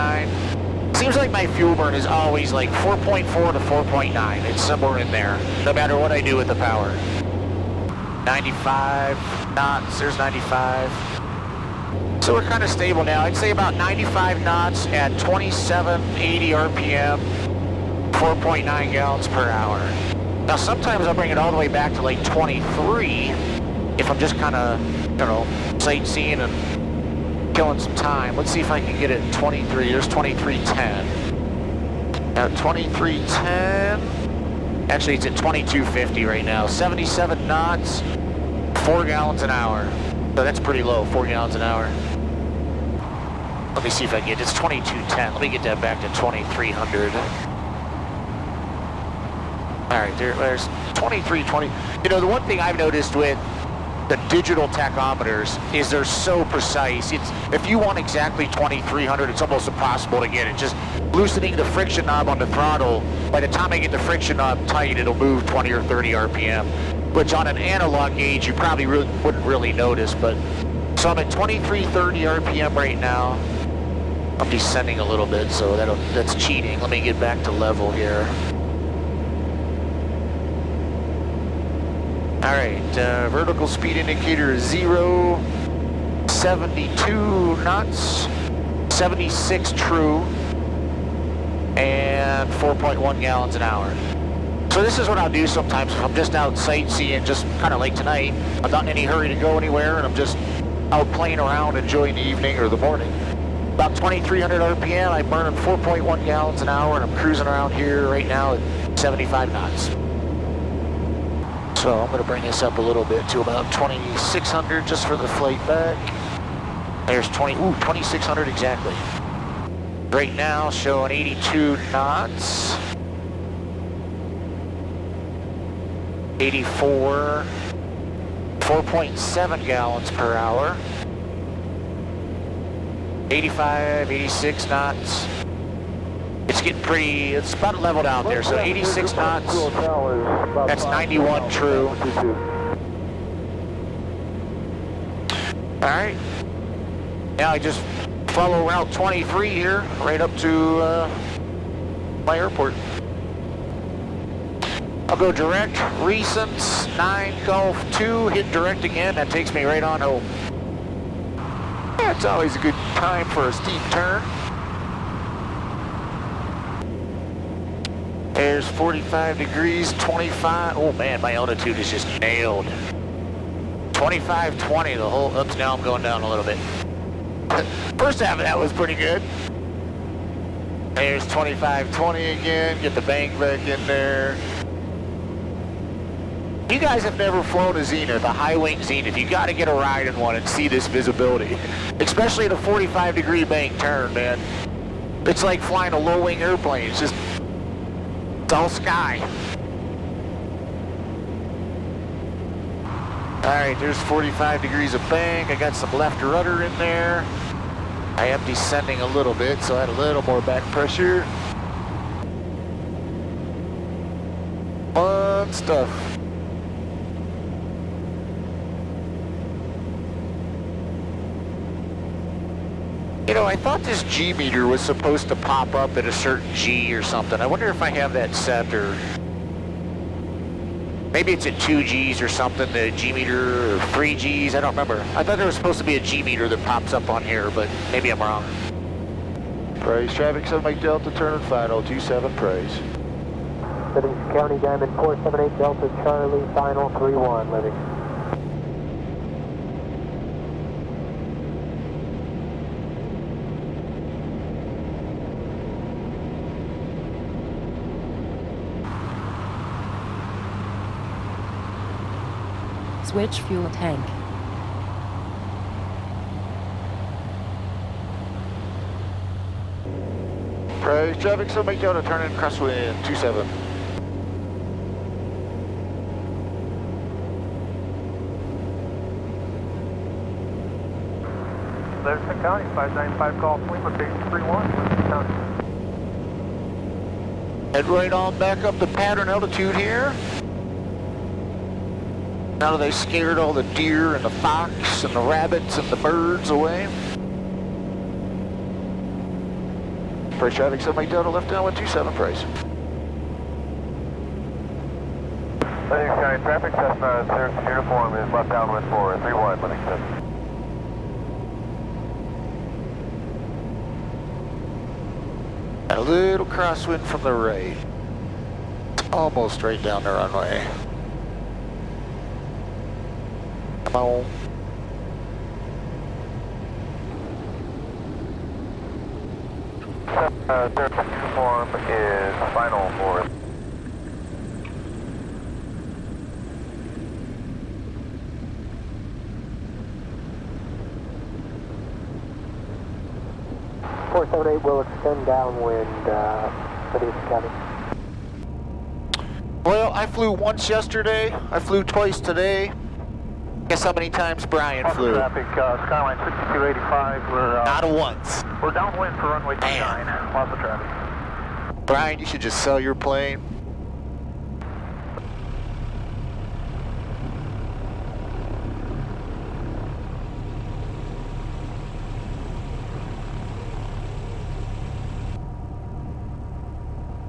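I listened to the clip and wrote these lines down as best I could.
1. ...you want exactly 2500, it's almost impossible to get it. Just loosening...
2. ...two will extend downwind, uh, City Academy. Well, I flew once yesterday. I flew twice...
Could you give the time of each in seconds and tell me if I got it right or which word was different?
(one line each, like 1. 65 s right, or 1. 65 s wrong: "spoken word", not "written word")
1. 57 s wrong: "2300", not "2500"
2. 344 s wrong: "eight", not "two".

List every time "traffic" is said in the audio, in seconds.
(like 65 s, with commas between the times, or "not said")
240 s, 271 s, 300 s, 306 s, 355 s, 360 s.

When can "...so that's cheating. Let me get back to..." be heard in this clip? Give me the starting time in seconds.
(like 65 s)
75 s.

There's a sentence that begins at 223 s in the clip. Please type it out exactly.
You know, I thought this G meter was supposed to pop up at a certain G or something.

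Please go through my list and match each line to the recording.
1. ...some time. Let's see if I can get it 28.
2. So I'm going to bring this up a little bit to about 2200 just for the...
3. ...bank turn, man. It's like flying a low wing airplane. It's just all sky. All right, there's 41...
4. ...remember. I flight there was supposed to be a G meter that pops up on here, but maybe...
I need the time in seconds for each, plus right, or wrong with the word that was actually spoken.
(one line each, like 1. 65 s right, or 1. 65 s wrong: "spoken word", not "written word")
1. 27 s wrong: "23", not "28"
2. 111 s wrong: "2600", not "2200"
3. 193 s wrong: "45", not "41"
4. 234 s wrong: "thought", not "flight".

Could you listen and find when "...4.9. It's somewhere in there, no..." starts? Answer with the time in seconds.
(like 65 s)
3 s.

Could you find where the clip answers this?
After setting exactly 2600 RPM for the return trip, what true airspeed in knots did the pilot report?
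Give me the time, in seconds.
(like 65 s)
140 s.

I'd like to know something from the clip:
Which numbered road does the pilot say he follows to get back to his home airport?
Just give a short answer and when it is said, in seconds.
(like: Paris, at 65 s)
Route 23, at 148 s.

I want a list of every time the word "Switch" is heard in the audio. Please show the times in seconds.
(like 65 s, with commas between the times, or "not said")
263 s.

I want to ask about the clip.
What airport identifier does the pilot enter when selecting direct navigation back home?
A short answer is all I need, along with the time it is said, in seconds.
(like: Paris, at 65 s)
9G2, at 156 s.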